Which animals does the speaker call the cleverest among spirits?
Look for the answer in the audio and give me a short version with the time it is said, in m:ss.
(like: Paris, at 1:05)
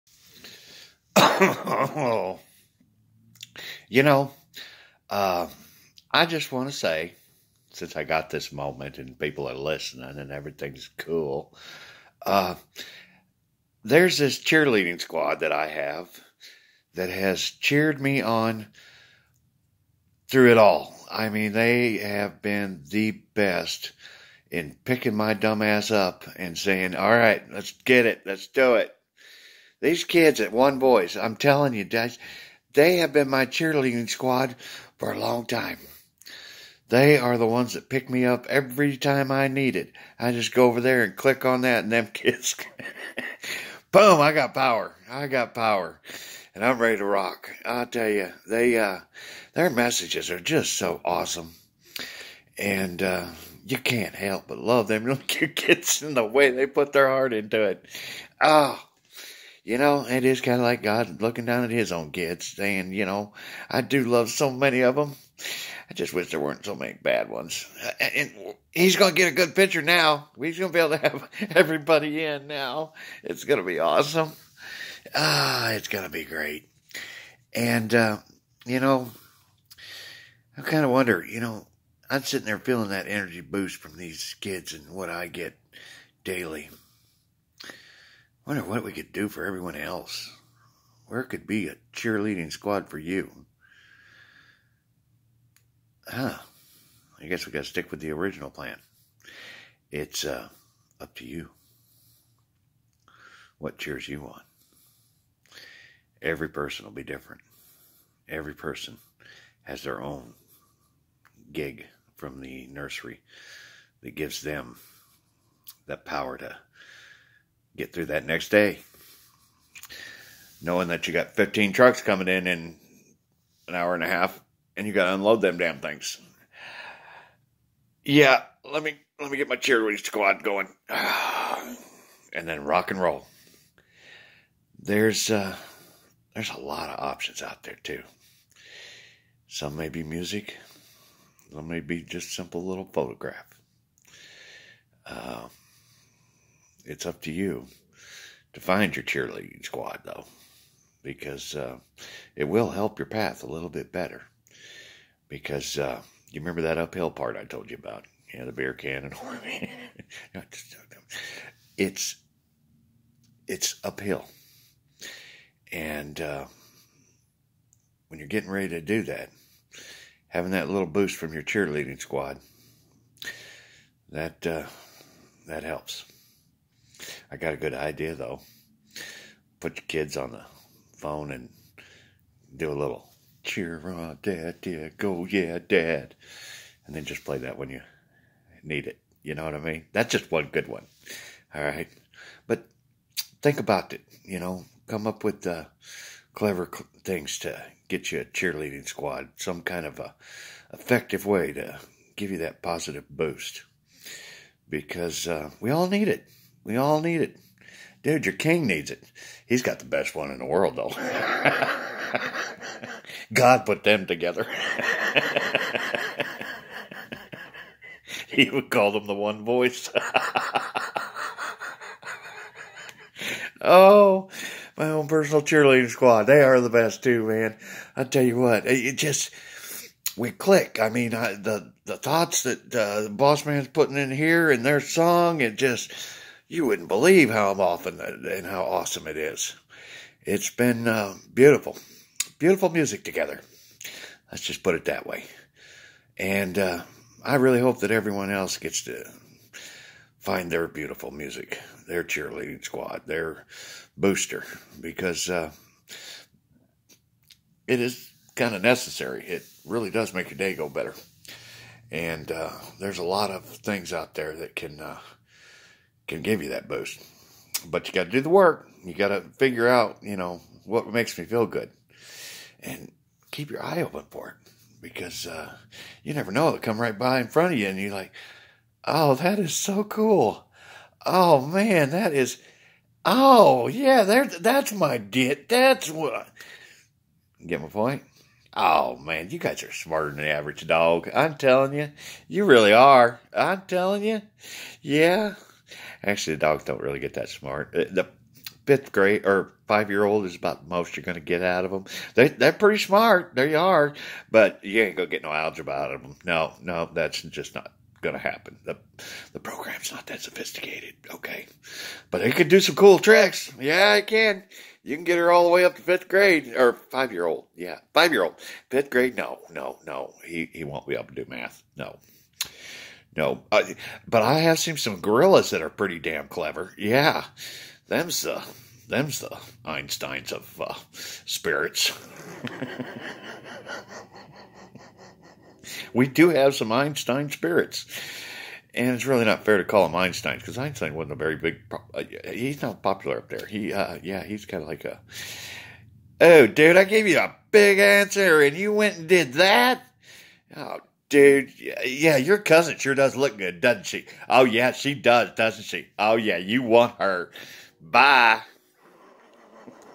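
gorillas, at 5:25.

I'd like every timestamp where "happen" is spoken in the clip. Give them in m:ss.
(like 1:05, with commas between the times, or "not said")
5:08.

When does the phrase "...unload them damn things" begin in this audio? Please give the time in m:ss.
2:05.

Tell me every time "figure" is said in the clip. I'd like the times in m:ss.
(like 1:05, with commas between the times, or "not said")
4:29.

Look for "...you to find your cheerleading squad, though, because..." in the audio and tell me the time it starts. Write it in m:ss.
2:27.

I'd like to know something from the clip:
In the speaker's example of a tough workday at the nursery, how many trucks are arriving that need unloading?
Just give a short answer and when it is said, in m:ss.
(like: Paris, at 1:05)
15, at 2:01.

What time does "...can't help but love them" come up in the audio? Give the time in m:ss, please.
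0:53.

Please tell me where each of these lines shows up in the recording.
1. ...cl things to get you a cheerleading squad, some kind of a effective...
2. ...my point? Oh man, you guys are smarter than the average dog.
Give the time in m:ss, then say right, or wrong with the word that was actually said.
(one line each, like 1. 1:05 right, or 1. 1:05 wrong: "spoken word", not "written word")
1. 3:16 right
2. 4:47 right.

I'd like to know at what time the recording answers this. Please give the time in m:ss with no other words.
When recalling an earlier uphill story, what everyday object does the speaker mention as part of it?
2:38.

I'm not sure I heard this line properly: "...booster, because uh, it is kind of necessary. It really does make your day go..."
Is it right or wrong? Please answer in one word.
right.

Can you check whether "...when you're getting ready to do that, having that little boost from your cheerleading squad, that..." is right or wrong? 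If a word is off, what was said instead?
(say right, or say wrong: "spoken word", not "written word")
right.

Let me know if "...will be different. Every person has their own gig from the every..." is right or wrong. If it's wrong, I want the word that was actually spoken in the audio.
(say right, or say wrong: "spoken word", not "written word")
wrong: "nursery", not "every".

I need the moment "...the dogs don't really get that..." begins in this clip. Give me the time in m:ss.
4:56.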